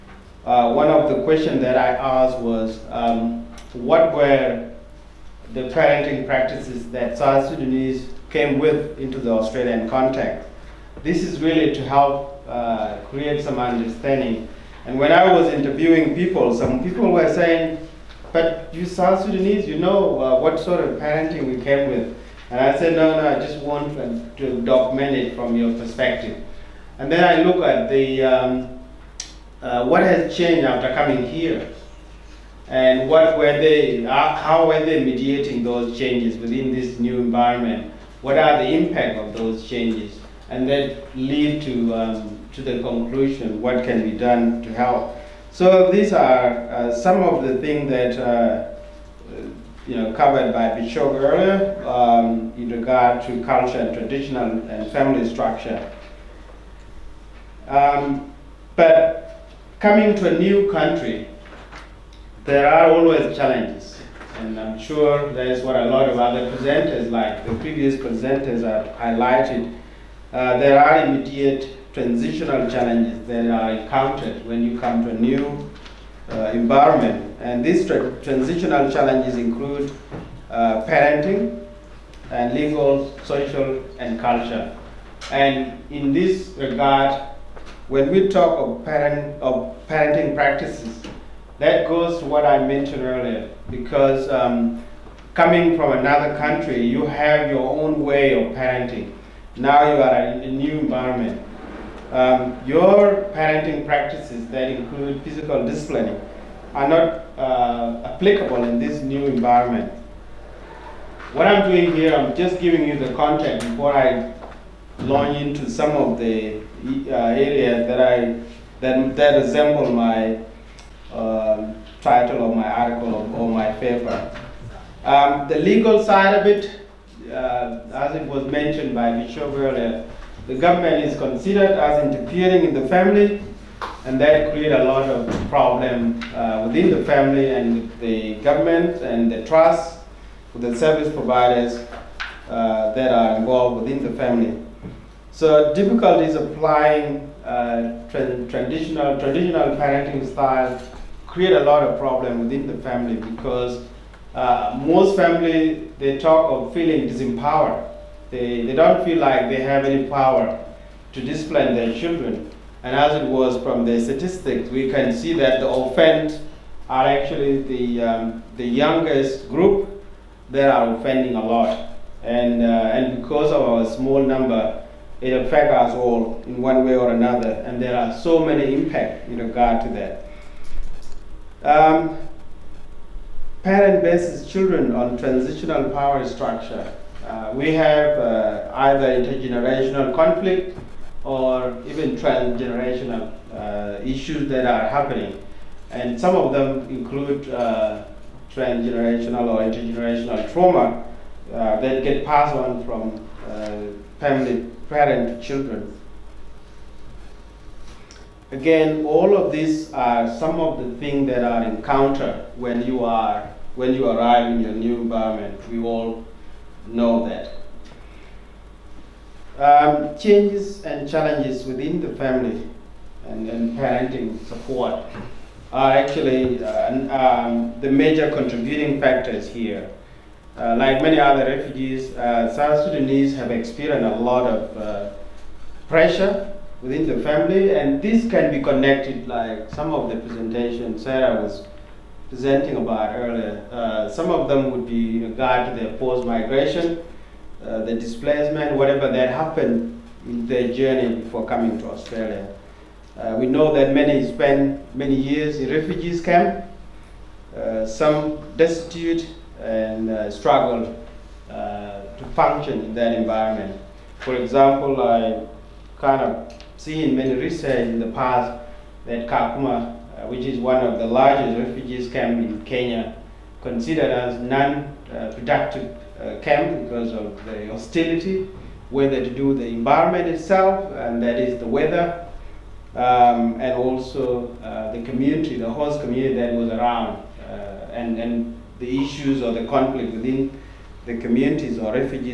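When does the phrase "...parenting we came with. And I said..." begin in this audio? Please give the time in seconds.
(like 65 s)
20 s.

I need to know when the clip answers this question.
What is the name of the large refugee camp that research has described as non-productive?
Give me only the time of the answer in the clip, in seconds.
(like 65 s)
269 s.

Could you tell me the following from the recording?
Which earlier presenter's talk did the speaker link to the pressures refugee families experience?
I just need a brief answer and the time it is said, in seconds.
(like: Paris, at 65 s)
Sarah, at 240 s.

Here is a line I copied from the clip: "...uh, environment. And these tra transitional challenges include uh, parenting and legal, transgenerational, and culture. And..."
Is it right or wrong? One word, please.
wrong.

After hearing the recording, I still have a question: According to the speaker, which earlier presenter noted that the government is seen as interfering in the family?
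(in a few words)
Michelle.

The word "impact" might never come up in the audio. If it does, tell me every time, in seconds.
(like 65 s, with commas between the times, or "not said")
38 s, 178 s.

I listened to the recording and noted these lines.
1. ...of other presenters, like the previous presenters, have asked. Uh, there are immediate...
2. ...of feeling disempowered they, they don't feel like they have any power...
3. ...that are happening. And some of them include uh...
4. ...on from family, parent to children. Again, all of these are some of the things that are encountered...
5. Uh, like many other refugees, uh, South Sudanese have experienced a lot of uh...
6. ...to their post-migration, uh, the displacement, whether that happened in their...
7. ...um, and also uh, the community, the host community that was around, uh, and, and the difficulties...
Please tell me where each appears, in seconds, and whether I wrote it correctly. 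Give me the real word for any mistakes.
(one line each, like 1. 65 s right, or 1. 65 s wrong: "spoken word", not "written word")
1. 66 s wrong: "highlighted", not "asked"
2. 156 s right
3. 194 s right
4. 202 s right
5. 230 s right
6. 245 s wrong: "whatever", not "whether"
7. 282 s wrong: "issues", not "difficulties".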